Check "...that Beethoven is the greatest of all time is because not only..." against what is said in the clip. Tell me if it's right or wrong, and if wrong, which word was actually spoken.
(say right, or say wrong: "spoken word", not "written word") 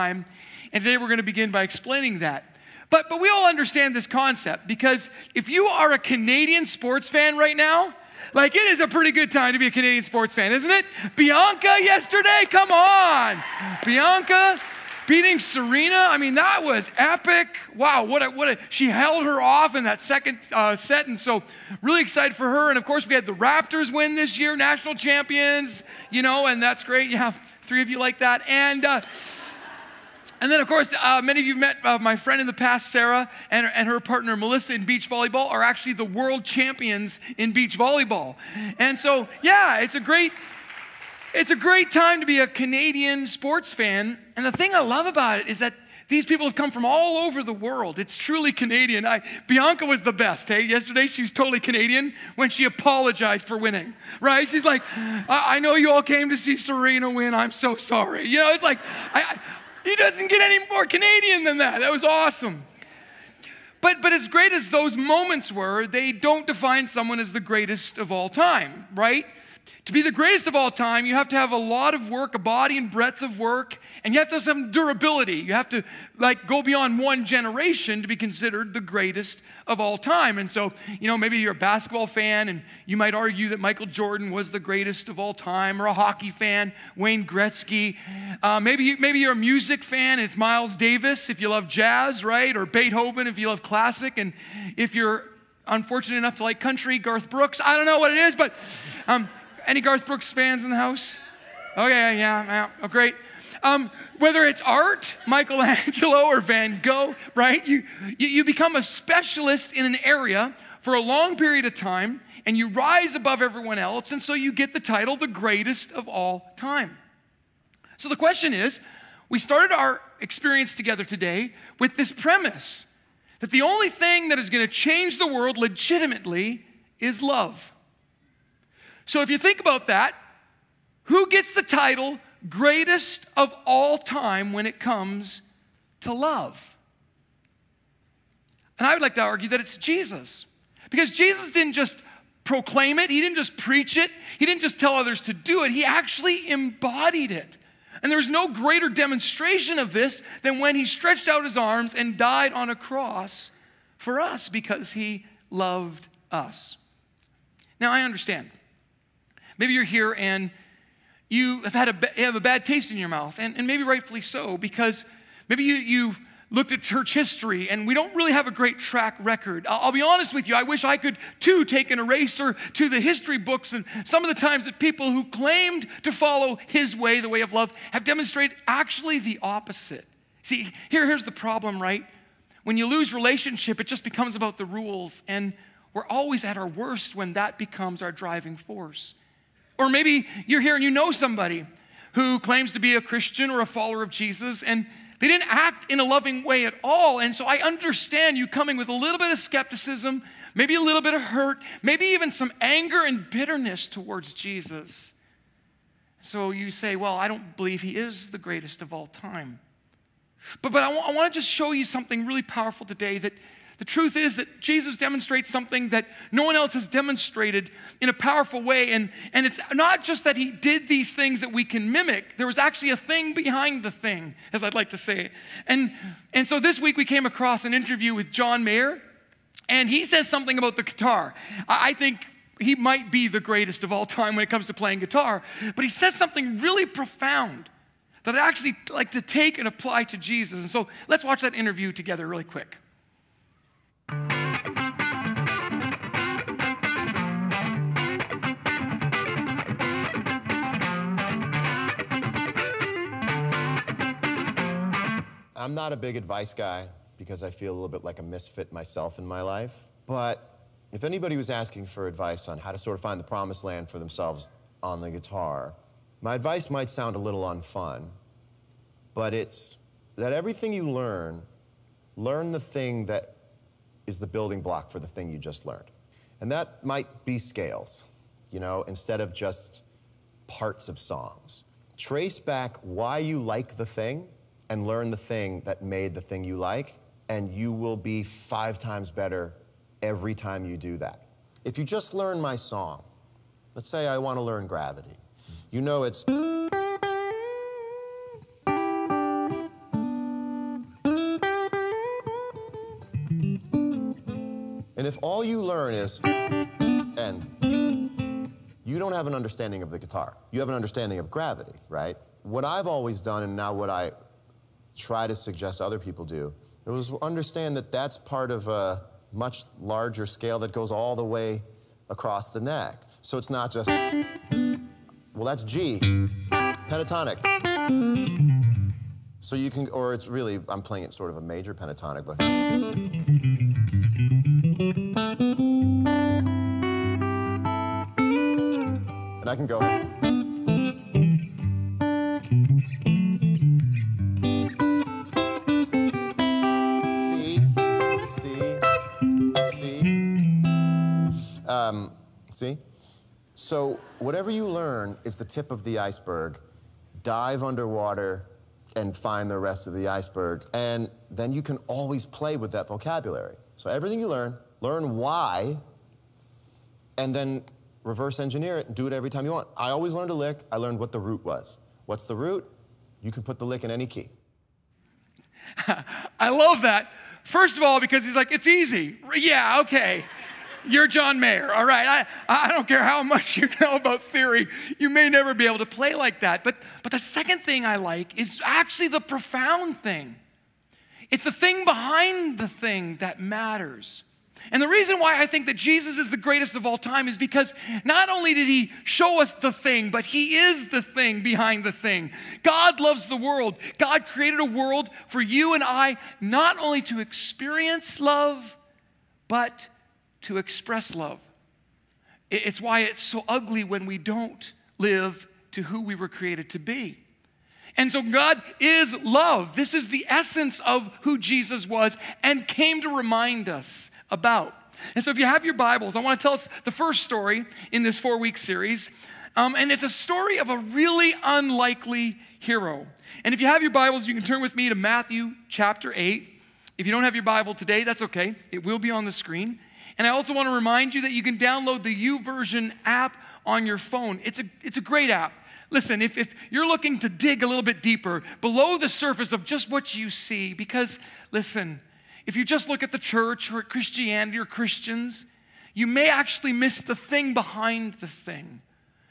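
wrong: "Jesus", not "Beethoven".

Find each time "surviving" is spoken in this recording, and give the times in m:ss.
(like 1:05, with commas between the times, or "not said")
not said.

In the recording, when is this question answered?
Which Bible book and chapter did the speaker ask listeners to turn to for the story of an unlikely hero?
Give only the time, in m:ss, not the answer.
7:14.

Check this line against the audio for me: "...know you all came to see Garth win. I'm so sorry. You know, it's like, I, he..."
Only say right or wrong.
wrong.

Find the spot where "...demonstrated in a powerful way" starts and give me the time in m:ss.
3:36.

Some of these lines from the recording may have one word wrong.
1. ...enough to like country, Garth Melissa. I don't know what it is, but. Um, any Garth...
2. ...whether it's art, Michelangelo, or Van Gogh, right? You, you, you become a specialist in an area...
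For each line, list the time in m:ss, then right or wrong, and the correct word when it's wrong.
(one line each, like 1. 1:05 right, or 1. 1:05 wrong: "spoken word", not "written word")
1. 1:36 wrong: "Brooks", not "Melissa"
2. 1:44 right.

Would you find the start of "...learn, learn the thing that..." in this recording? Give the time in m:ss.
4:30.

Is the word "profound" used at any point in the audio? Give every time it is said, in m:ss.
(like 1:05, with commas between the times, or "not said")
3:56, 6:29.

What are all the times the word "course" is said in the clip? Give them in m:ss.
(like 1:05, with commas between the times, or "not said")
0:22, 0:30.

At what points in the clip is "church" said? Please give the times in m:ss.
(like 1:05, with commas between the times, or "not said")
2:46, 7:33.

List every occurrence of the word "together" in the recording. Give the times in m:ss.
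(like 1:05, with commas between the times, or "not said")
2:00, 4:01.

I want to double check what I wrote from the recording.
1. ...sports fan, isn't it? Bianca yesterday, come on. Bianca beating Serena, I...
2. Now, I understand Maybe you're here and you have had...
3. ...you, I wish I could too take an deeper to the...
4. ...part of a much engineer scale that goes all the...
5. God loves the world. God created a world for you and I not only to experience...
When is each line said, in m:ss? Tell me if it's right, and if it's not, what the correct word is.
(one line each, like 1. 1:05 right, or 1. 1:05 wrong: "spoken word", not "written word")
1. 0:10 right
2. 2:37 right
3. 2:50 wrong: "eraser", not "deeper"
4. 5:18 wrong: "larger", not "engineer"
5. 6:42 right.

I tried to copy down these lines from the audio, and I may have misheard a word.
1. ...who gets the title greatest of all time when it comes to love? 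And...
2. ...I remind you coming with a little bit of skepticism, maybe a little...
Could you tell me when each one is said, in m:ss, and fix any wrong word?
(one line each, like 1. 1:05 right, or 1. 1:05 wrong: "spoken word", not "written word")
1. 2:11 right
2. 3:17 wrong: "understand", not "remind".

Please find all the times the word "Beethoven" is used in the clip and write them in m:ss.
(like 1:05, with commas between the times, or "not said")
1:32.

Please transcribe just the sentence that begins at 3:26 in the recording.
So you say, Well, I don't believe he is the greatest of all time.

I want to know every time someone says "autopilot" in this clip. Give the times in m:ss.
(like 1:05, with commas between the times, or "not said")
not said.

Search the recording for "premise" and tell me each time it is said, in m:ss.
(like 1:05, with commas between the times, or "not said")
2:02.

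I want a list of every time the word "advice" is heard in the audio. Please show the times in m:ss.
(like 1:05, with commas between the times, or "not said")
4:16, 4:22, 4:26.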